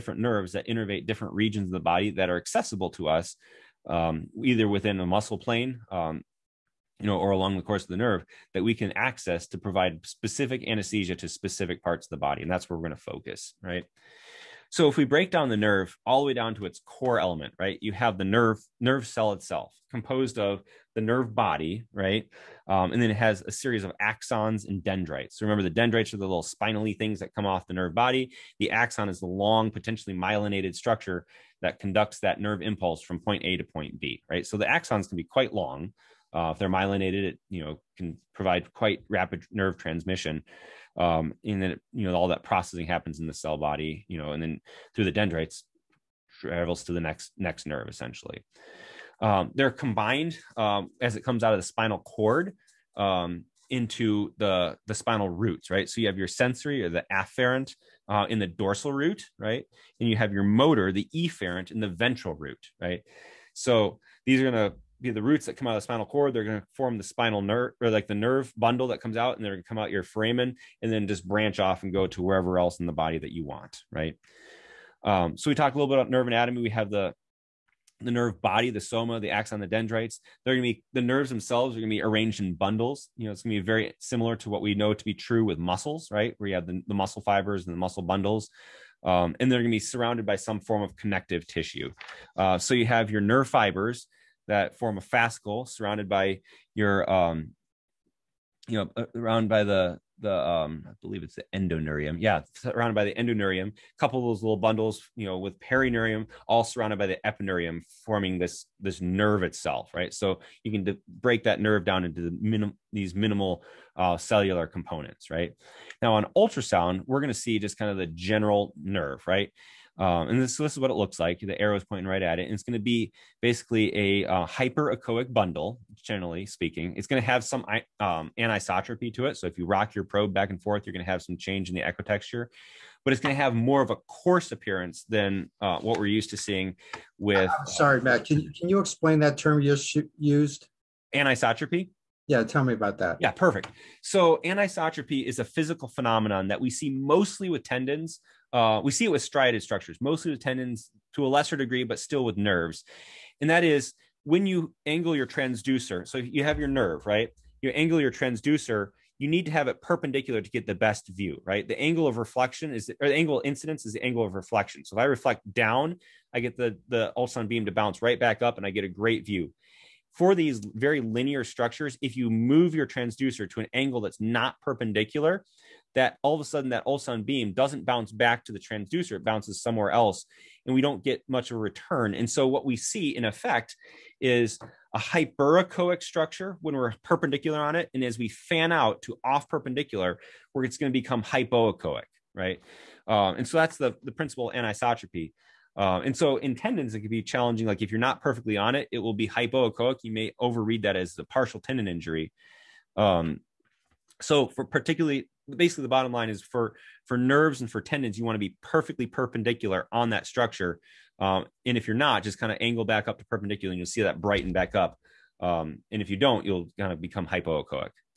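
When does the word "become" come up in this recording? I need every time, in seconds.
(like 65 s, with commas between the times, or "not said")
190 s, 217 s.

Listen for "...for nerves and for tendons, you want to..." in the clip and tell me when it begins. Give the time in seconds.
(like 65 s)
207 s.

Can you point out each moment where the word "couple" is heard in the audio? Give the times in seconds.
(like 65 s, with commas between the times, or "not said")
104 s.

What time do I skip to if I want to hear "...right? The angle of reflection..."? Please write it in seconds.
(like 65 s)
161 s.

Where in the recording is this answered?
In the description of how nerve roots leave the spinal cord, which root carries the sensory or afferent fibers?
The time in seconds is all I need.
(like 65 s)
58 s.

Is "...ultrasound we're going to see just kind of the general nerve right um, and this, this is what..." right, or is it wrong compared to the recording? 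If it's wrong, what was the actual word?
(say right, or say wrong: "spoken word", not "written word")
right.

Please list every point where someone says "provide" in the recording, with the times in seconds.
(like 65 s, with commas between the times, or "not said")
9 s, 38 s.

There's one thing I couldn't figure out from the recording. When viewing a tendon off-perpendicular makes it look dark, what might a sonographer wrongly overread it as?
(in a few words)
Partial tendon injury.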